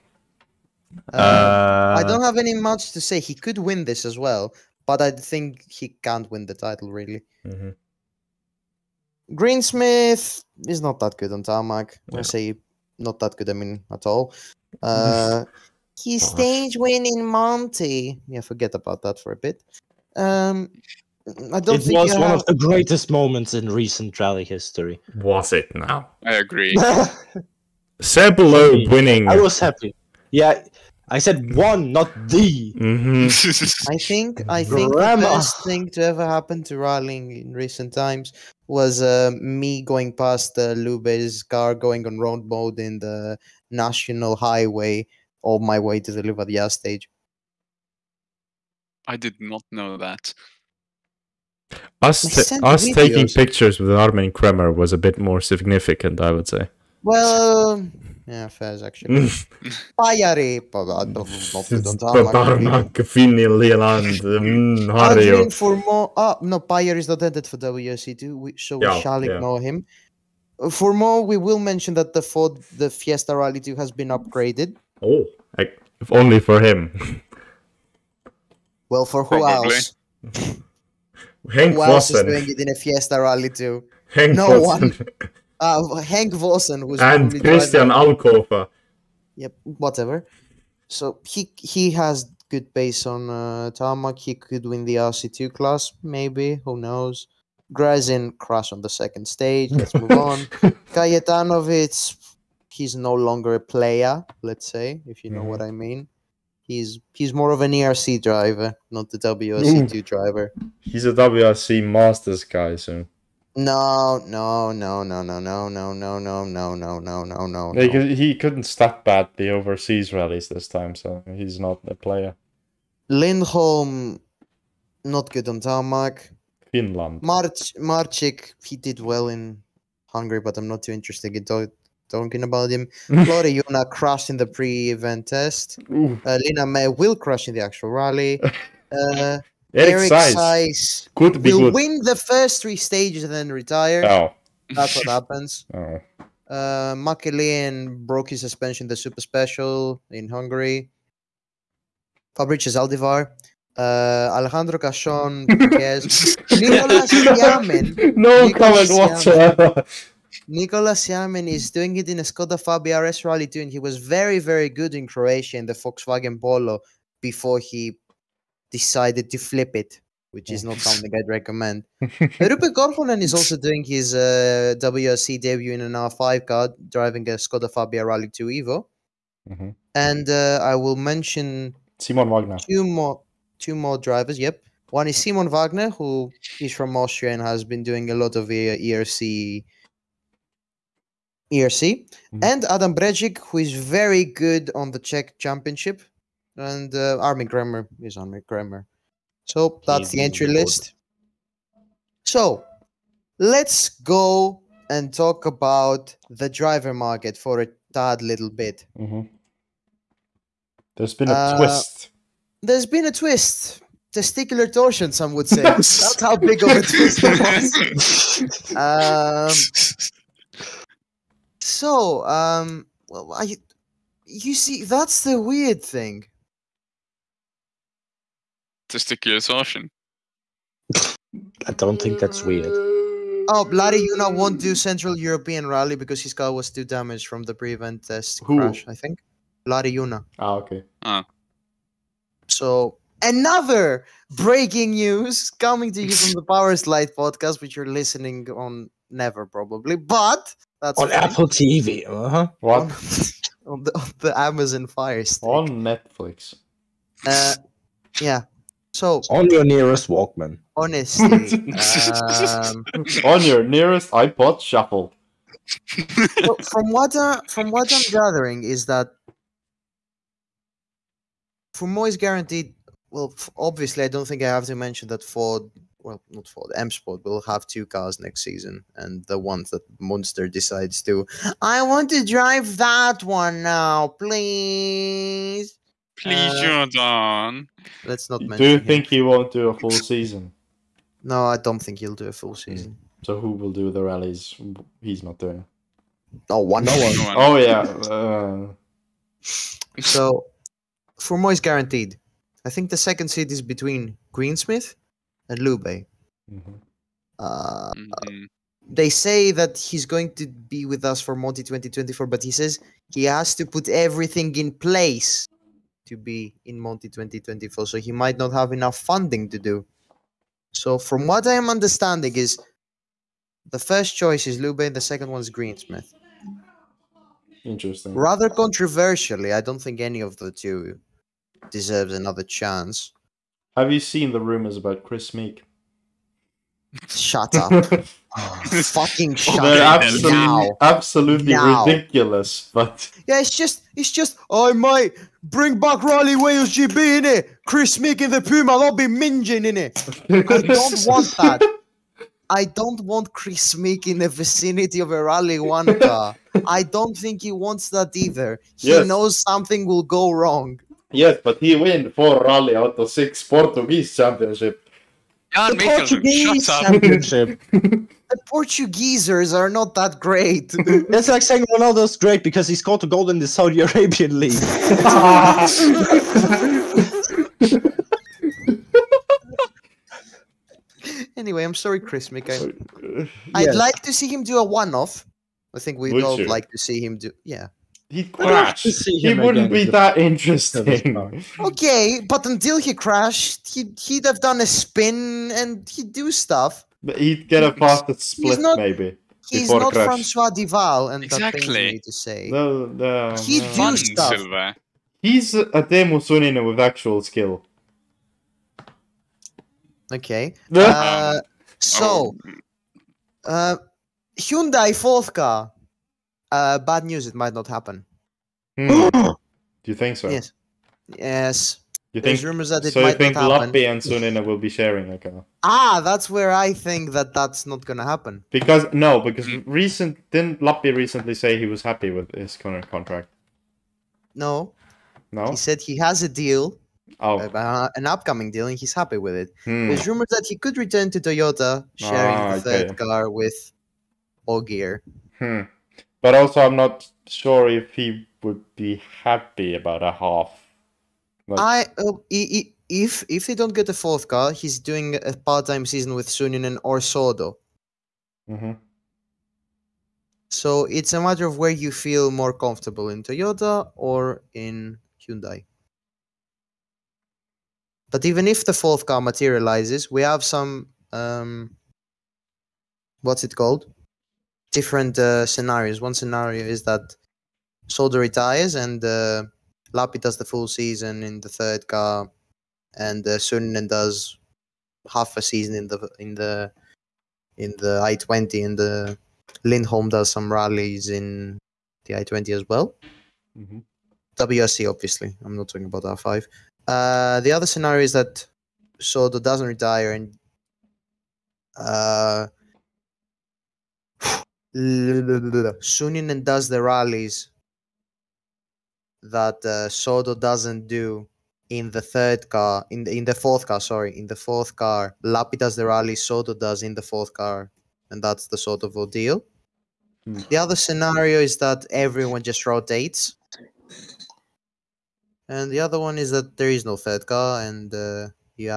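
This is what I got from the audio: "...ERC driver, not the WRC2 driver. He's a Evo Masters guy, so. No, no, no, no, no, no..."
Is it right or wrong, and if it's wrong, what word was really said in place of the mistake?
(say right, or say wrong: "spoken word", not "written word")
wrong: "WRC", not "Evo".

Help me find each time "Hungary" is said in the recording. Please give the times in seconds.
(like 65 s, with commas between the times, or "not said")
130 s, 150 s.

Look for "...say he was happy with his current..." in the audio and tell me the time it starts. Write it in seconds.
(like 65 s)
431 s.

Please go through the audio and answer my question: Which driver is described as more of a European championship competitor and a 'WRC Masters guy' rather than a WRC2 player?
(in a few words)
Kajetanowicz.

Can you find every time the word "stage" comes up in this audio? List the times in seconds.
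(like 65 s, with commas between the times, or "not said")
16 s, 46 s, 99 s, 142 s.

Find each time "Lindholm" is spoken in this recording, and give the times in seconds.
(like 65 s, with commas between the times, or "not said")
123 s, 489 s.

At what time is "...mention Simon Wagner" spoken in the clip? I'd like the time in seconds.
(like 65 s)
180 s.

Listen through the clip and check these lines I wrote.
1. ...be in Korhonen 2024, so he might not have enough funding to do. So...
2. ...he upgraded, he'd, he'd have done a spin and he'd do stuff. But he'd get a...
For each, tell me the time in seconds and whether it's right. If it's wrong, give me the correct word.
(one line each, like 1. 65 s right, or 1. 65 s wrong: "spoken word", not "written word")
1. 316 s wrong: "Monty", not "Korhonen"
2. 392 s wrong: "crashed", not "upgraded".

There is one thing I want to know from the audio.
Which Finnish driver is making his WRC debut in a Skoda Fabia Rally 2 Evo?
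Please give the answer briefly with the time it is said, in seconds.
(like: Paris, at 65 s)
Roope Korhonen, at 172 s.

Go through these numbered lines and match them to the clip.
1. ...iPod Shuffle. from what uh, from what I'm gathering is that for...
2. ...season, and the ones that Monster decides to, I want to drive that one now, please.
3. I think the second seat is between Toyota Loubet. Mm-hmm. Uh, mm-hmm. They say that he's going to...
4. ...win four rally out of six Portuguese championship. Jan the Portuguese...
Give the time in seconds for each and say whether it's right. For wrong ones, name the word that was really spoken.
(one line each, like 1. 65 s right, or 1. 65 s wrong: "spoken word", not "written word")
1. 264 s right
2. 278 s right
3. 302 s wrong: "Greensmith", not "Toyota"
4. 361 s right.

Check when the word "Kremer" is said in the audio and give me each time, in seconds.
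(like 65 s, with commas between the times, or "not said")
54 s, 198 s.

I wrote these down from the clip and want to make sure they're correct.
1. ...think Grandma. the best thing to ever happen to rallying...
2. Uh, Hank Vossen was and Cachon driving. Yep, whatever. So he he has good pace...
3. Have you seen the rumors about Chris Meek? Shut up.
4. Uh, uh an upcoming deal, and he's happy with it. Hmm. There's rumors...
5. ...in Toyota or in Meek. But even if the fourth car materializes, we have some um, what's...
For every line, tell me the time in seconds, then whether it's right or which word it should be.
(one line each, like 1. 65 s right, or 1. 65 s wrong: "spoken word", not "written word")
1. 34 s right
2. 85 s wrong: "Christian", not "Cachon"
3. 333 s right
4. 437 s right
5. 463 s wrong: "Hyundai", not "Meek".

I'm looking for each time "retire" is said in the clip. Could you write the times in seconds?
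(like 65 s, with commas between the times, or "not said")
143 s, 478 s, 499 s.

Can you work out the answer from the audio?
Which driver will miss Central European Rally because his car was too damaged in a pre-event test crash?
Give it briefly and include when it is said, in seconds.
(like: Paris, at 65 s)
Lauri Joona, at 239 s.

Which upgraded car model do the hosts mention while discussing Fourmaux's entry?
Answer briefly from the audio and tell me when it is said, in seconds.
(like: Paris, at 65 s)
Fiesta Rally 2, at 72 s.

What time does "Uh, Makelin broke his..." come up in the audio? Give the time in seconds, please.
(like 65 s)
146 s.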